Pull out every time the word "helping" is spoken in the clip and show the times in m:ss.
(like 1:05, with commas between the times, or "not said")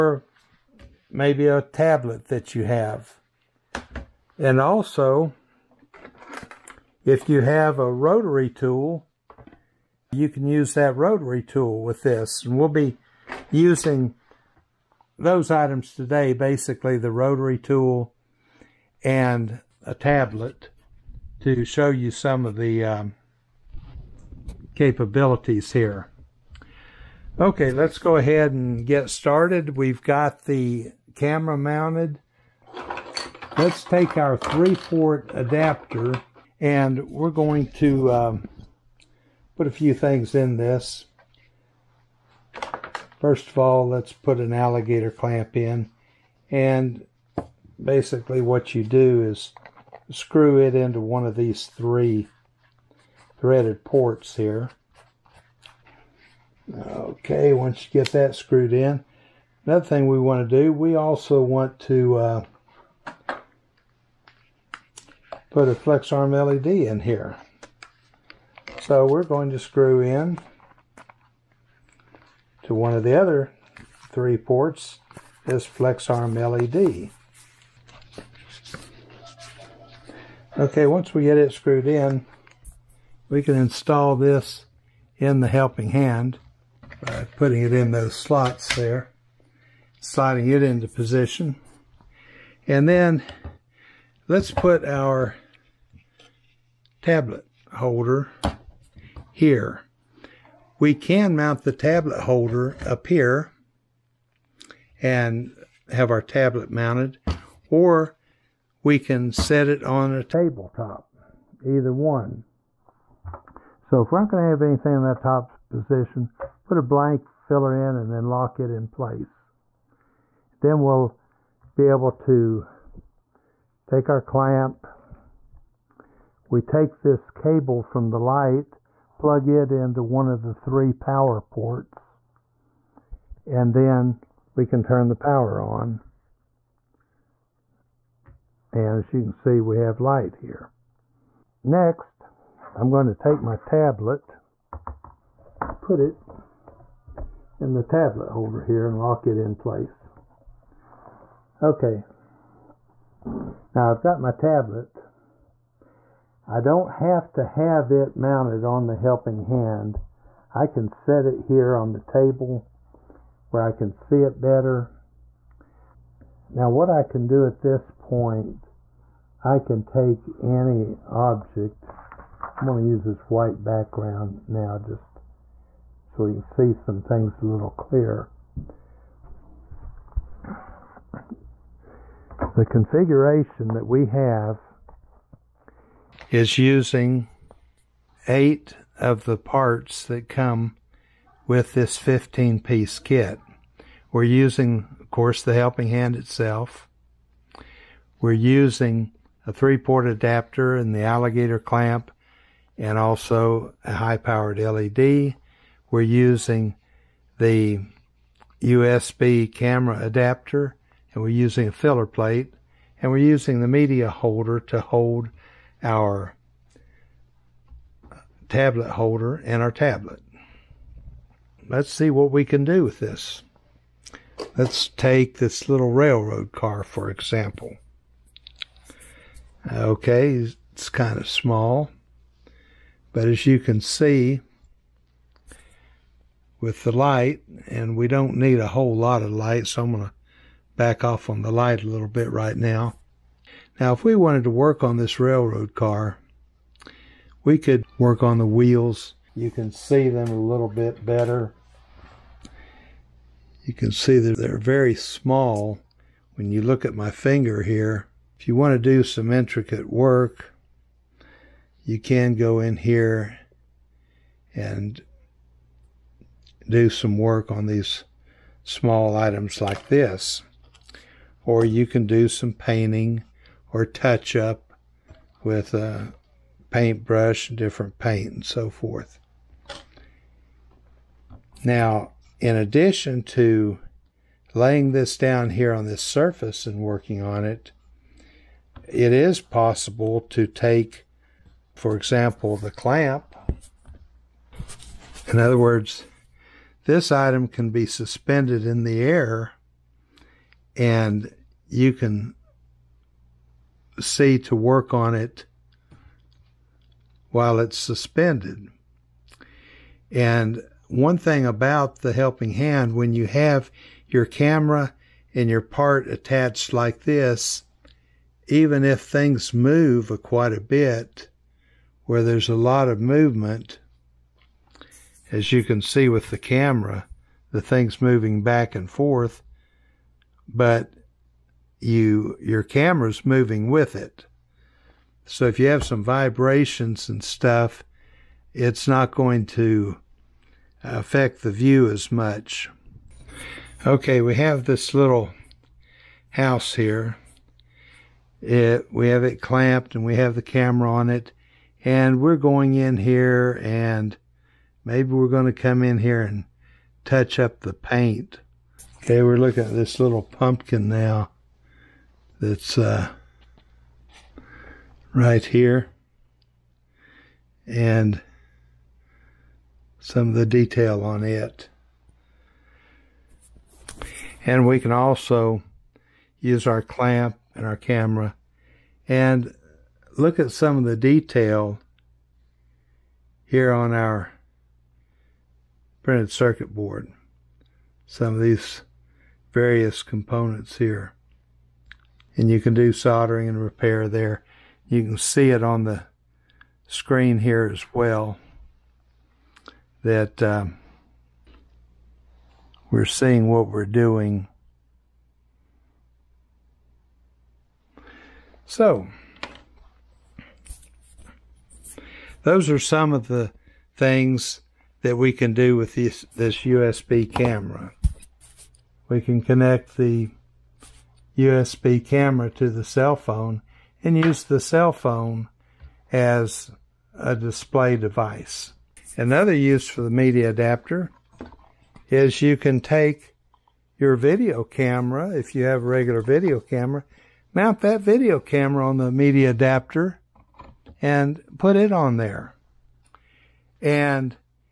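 1:25, 2:38, 3:15, 5:12.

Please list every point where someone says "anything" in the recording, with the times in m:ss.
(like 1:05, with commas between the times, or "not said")
1:54.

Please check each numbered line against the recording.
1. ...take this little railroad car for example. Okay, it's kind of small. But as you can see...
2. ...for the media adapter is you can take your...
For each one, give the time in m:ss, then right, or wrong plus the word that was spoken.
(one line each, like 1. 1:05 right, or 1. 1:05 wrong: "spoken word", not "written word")
1. 3:44 right
2. 7:09 right.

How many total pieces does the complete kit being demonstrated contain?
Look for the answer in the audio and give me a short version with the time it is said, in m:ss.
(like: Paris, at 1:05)
15, at 3:11.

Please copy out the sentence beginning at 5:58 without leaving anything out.
Okay, we're looking at this little pumpkin now that's uh, right here.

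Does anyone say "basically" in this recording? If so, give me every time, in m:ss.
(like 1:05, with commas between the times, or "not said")
0:16, 0:47.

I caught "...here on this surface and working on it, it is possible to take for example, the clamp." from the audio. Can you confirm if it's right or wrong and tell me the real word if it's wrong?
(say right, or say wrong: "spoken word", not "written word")
right.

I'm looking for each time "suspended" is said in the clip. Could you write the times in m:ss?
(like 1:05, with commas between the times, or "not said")
4:57, 5:07.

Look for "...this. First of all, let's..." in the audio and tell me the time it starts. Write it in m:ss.
0:40.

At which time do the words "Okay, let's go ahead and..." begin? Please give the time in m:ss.
0:27.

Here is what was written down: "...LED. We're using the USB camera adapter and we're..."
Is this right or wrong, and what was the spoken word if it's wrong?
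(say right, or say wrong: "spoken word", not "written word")
right.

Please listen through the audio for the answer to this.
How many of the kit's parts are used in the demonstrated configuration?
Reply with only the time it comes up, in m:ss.
3:08.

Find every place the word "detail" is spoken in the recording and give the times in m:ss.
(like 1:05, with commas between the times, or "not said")
6:10, 6:20.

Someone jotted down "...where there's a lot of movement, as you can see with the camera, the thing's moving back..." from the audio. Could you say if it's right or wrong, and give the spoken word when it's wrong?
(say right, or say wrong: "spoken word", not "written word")
right.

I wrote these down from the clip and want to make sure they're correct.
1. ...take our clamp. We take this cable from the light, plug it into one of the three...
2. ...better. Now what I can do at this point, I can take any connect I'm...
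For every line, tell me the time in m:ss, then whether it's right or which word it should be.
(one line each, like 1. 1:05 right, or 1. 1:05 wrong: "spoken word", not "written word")
1. 2:03 right
2. 2:44 wrong: "object", not "connect".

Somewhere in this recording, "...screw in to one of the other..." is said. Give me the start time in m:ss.
1:09.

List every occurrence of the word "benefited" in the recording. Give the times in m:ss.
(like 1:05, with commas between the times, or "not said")
not said.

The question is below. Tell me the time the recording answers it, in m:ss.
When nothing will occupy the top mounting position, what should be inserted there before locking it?
1:56.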